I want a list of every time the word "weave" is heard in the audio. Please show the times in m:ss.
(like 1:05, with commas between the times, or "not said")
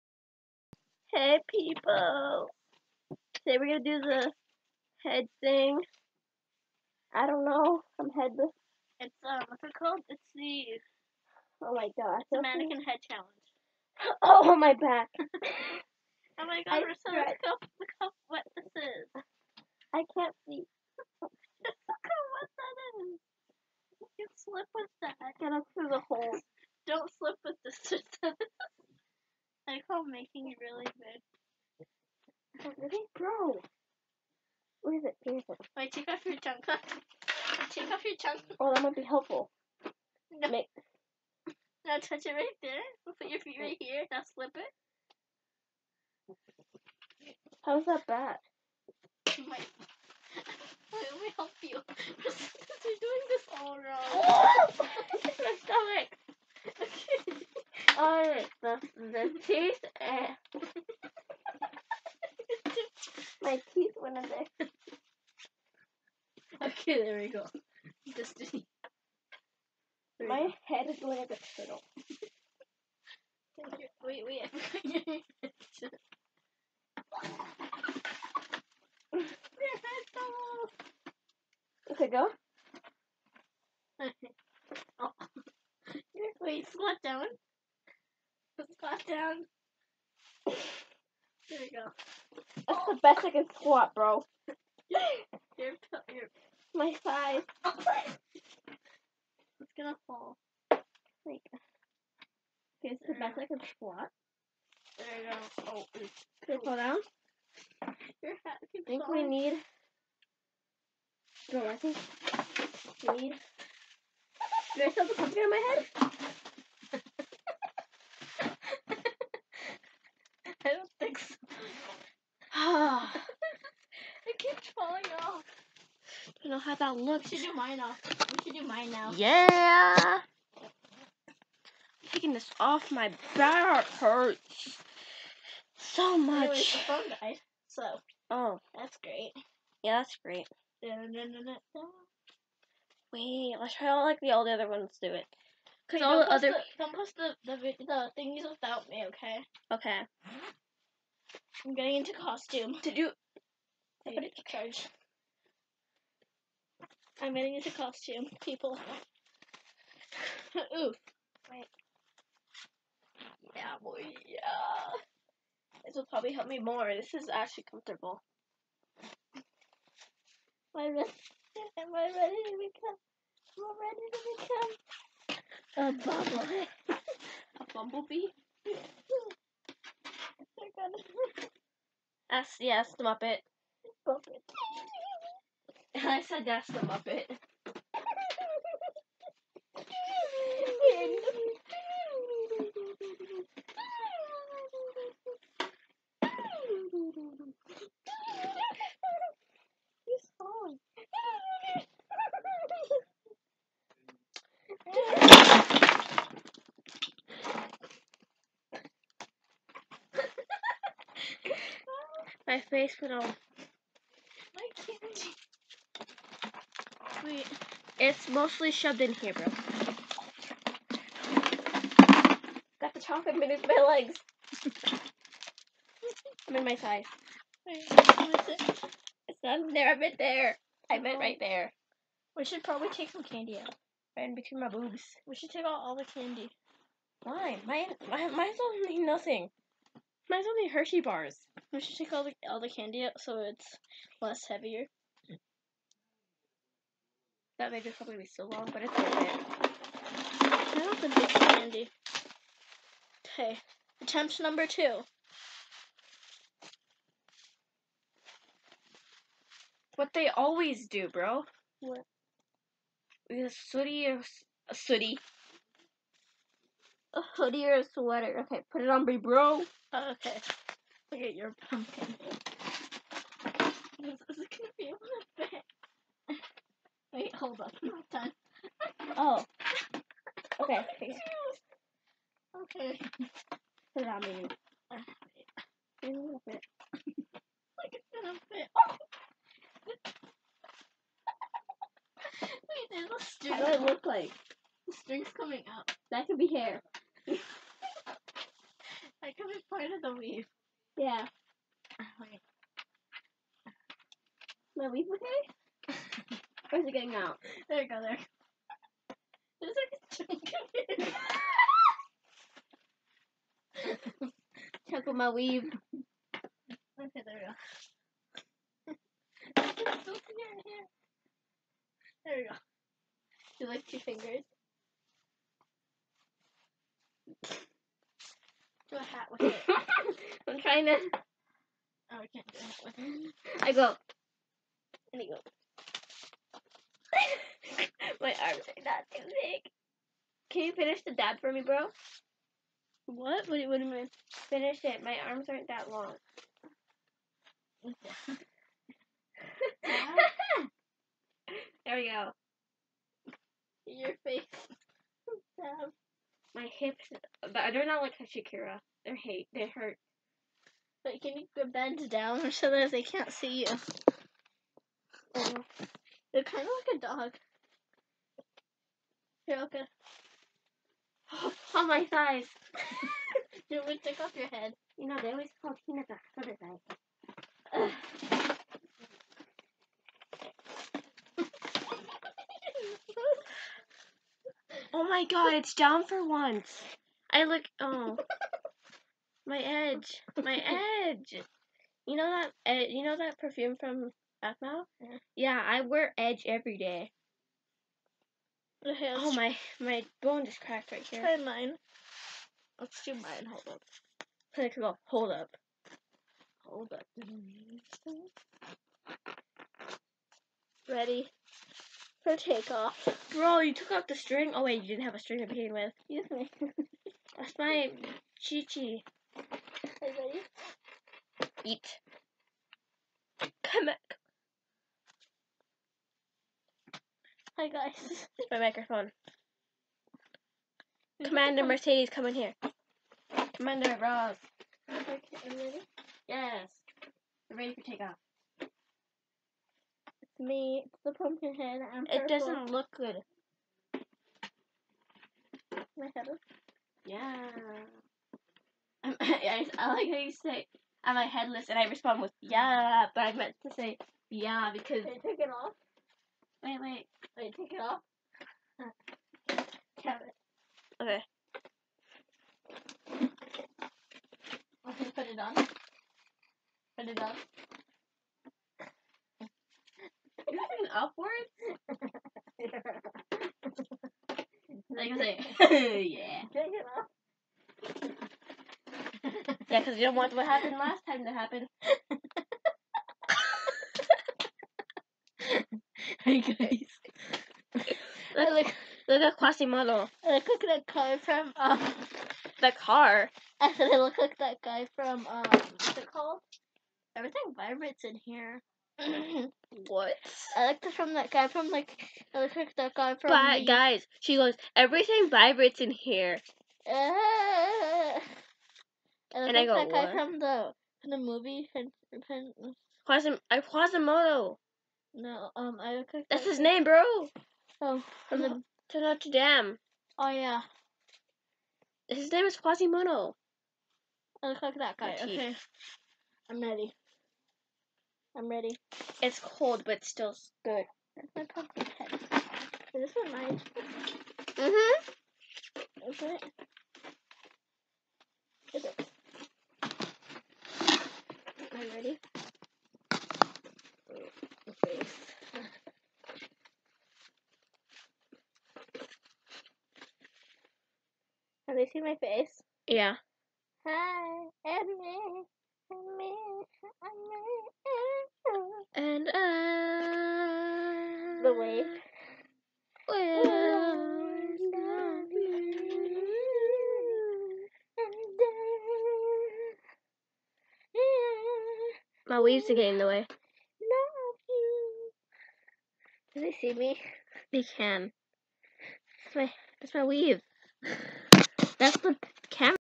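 5:00, 5:04, 5:15, 9:40.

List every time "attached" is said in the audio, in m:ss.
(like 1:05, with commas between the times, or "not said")
not said.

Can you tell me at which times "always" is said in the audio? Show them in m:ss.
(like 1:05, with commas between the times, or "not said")
4:20, 6:15.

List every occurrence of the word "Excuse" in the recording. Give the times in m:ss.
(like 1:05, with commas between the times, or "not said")
6:56.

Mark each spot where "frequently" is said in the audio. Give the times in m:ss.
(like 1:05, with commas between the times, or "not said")
not said.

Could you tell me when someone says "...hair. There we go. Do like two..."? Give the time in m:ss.
5:20.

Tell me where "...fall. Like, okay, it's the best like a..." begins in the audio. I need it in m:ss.
1:40.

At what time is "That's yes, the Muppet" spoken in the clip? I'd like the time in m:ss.
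3:02.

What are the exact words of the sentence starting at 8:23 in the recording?
But guys, she goes everything vibrates in here.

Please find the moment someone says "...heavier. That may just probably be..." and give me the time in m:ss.
4:04.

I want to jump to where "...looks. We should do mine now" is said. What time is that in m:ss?
2:06.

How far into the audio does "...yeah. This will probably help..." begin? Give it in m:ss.
2:44.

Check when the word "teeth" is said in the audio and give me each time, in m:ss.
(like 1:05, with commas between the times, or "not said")
0:59, 1:03.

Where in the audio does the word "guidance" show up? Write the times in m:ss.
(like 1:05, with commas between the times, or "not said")
not said.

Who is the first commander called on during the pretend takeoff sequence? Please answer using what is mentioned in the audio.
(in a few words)
Commander Mercedes.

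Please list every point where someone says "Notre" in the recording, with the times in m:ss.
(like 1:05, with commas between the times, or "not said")
8:39.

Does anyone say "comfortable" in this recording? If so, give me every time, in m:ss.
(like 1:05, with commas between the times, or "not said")
2:47.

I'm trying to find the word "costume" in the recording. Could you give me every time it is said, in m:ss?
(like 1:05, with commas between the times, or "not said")
2:32, 2:37.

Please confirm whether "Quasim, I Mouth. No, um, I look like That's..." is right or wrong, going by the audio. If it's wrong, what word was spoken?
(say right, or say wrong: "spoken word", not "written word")
wrong: "Quasimodo", not "Mouth".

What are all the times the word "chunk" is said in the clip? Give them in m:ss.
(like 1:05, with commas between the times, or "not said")
5:10.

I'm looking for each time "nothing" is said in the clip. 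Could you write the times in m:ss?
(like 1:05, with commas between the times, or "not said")
3:58.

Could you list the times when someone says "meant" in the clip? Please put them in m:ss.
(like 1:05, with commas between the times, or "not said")
3:50, 7:33.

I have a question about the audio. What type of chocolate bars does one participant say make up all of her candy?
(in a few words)
Hershey bars.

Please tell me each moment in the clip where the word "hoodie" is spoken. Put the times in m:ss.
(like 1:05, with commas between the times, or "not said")
4:27.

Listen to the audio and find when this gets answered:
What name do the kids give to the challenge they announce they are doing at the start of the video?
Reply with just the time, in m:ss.
0:12.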